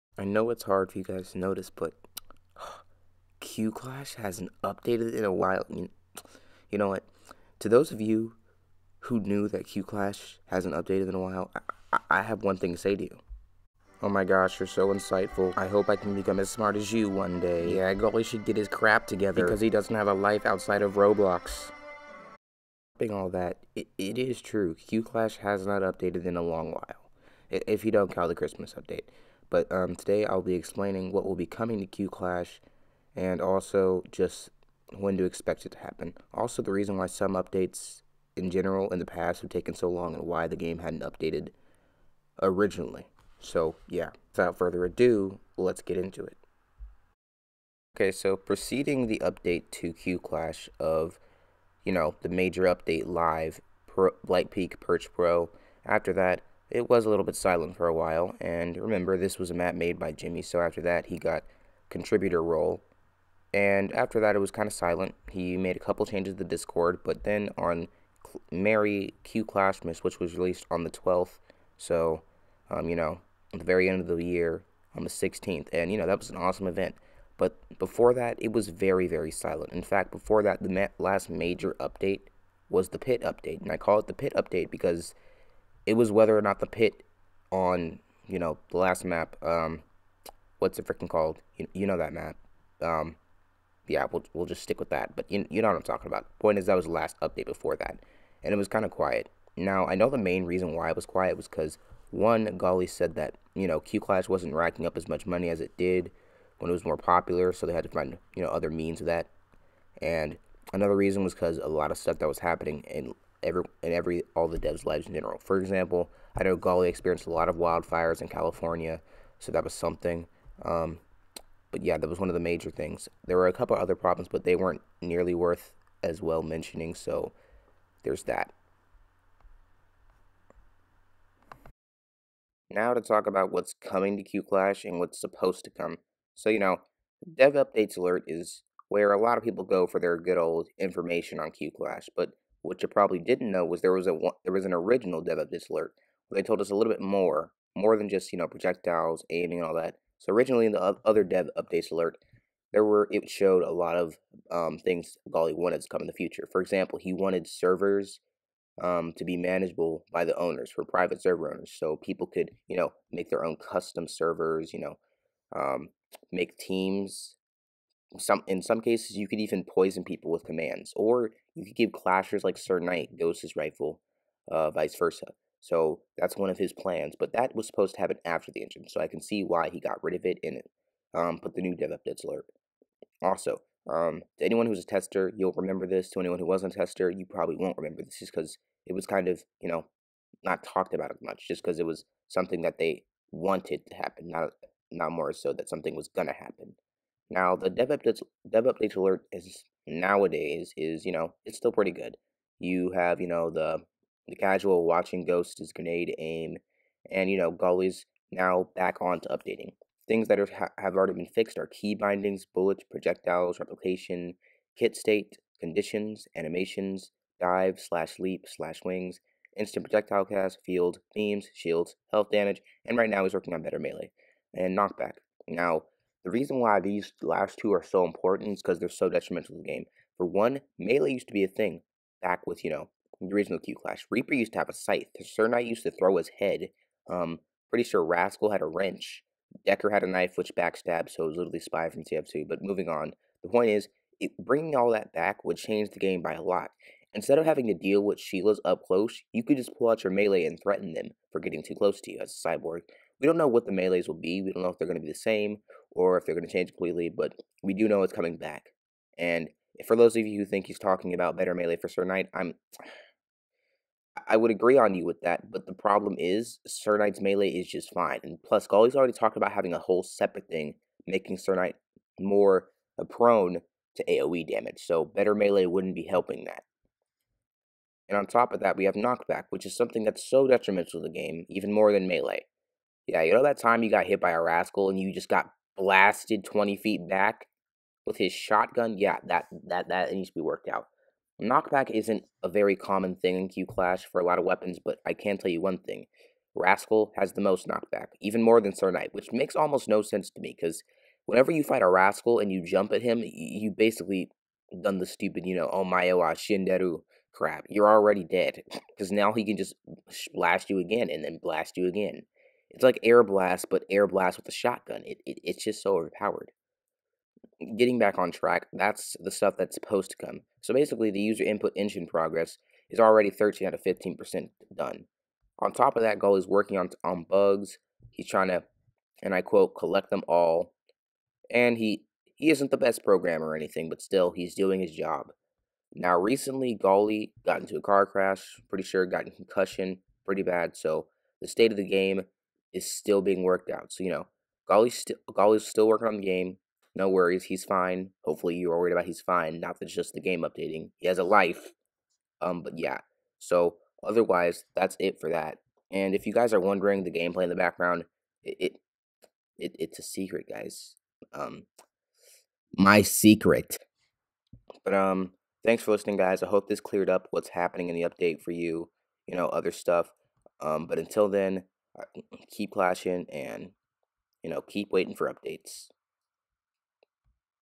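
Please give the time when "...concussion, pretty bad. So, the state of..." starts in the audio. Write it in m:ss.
5:39.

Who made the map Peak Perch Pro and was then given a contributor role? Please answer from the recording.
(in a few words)
Jimmy.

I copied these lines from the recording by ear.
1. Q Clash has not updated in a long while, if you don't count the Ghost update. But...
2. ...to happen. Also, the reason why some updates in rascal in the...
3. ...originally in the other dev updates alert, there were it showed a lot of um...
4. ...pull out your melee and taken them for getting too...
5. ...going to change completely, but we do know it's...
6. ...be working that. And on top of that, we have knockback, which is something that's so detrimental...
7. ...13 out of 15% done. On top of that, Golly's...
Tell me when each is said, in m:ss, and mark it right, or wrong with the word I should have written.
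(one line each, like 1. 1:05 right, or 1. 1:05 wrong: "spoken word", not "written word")
1. 0:24 wrong: "Christmas", not "Ghost"
2. 0:35 wrong: "general", not "rascal"
3. 2:30 right
4. 4:09 wrong: "threaten", not "taken"
5. 4:16 right
6. 4:35 wrong: "helping", not "working"
7. 5:23 right.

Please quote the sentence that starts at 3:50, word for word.
For one, melee used to be a thing back with, you know, the original Q Clash.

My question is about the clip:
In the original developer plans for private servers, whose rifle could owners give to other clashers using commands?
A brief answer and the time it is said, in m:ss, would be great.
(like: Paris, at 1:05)
Sir Knight Ghost's, at 2:52.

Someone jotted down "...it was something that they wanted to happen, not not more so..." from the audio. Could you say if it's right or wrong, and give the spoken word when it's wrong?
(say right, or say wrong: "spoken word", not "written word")
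right.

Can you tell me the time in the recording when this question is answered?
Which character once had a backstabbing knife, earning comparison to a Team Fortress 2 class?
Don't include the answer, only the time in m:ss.
3:59.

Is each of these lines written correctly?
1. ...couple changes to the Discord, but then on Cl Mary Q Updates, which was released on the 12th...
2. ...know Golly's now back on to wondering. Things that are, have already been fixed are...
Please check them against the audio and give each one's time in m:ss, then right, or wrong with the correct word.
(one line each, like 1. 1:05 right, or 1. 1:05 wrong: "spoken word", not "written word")
1. 1:05 wrong: "Clashmas", not "Updates"
2. 3:27 wrong: "updating", not "wondering".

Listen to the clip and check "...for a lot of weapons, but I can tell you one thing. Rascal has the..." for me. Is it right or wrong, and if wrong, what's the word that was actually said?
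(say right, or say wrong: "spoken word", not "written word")
right.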